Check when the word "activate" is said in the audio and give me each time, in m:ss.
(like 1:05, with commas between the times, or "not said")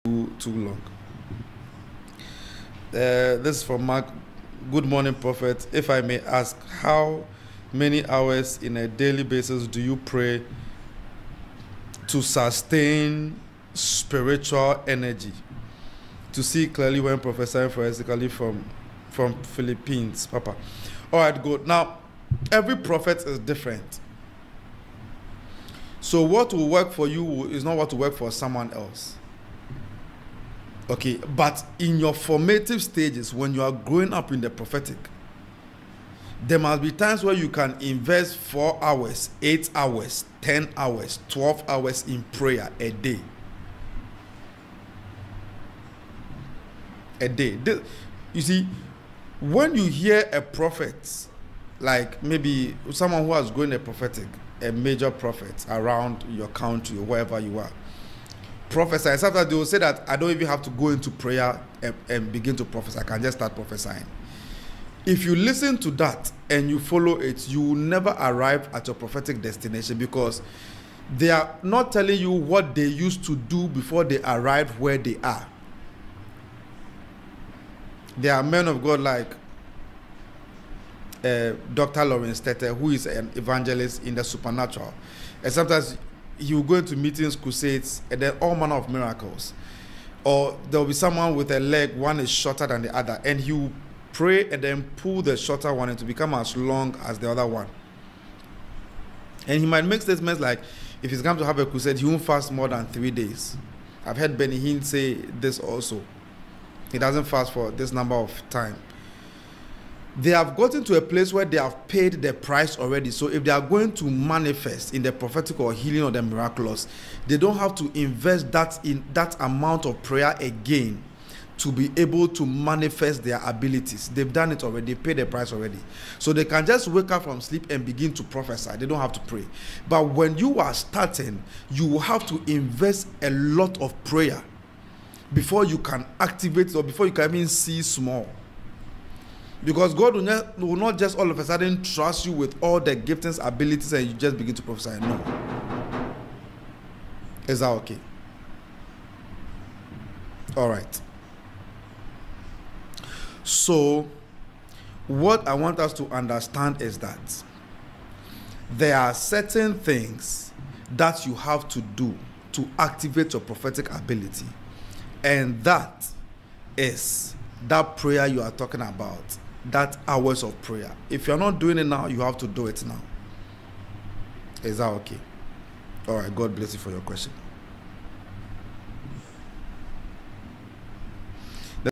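2:16, 2:42.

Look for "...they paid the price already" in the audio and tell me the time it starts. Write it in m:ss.
2:04.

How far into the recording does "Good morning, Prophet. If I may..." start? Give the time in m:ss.
0:04.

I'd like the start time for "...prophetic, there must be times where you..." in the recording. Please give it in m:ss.
0:34.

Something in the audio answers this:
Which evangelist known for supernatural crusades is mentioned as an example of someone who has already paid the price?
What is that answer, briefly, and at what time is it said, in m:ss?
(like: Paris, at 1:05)
Dr. Lawrence Tetteh, at 1:21.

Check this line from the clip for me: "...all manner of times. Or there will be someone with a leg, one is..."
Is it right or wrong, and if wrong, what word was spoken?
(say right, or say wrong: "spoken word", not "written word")
wrong: "miracles", not "times".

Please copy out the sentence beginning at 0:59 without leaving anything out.
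Sometimes they will say that I don't even have to go into prayer and, and begin to prophesy.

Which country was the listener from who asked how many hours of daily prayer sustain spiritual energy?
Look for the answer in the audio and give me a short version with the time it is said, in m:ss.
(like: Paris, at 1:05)
Philippines, at 0:19.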